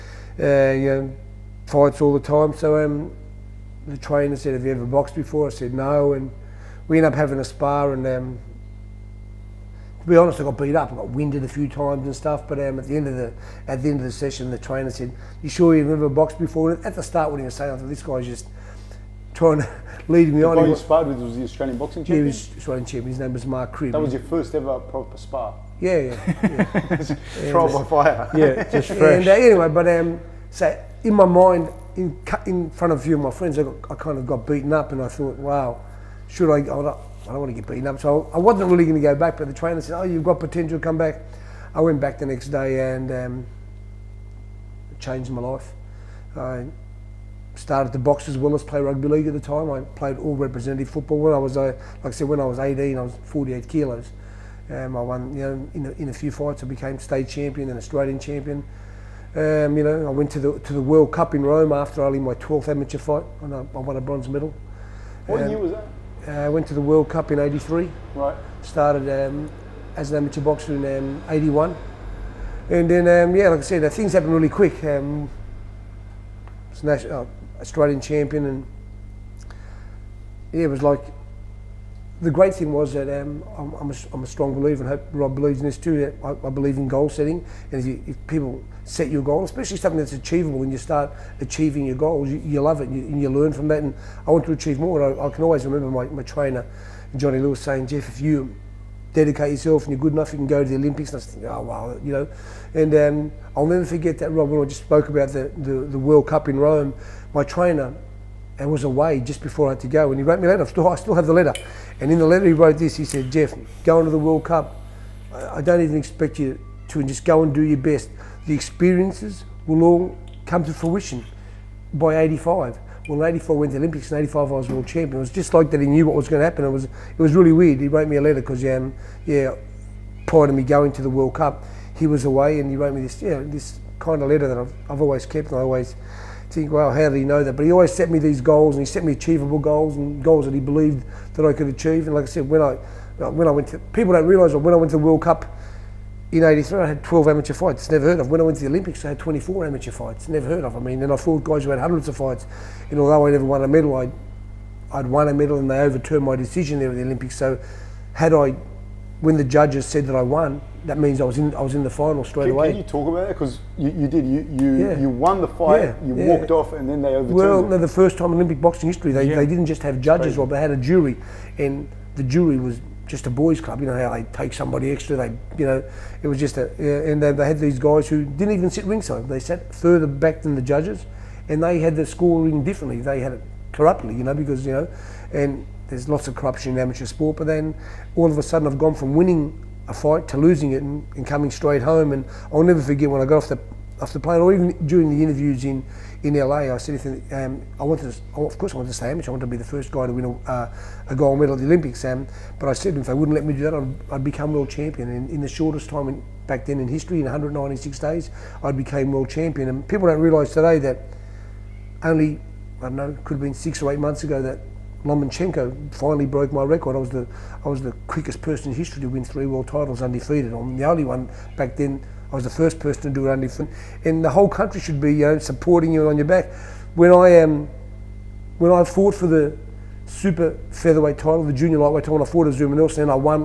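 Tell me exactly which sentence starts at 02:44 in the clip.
you won the fight, yeah, you yeah.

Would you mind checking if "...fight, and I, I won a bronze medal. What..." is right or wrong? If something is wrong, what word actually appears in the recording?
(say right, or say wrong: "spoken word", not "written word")
right.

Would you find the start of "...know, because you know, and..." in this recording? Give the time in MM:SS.
03:04.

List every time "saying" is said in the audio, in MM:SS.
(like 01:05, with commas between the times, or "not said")
00:17, 01:37.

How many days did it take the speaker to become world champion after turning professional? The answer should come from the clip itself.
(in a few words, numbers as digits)
196.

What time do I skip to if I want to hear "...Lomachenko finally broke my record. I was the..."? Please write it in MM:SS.
03:35.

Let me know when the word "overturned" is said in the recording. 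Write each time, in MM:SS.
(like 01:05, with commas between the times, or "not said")
02:35, 02:47.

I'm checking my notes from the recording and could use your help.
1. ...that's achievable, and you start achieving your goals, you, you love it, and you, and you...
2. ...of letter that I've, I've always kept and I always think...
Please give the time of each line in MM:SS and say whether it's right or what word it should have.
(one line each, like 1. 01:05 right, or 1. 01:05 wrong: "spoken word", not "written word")
1. 01:29 right
2. 02:14 right.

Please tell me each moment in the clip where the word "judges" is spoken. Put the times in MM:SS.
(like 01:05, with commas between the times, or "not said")
02:39, 02:50, 03:00.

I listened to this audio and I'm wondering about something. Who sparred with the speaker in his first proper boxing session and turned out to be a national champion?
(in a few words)
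Mark Cribb.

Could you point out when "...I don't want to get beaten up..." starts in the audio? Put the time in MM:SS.
00:37.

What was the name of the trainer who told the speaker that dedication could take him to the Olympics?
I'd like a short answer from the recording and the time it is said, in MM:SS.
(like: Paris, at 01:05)
Johnny Lewis, at 01:37.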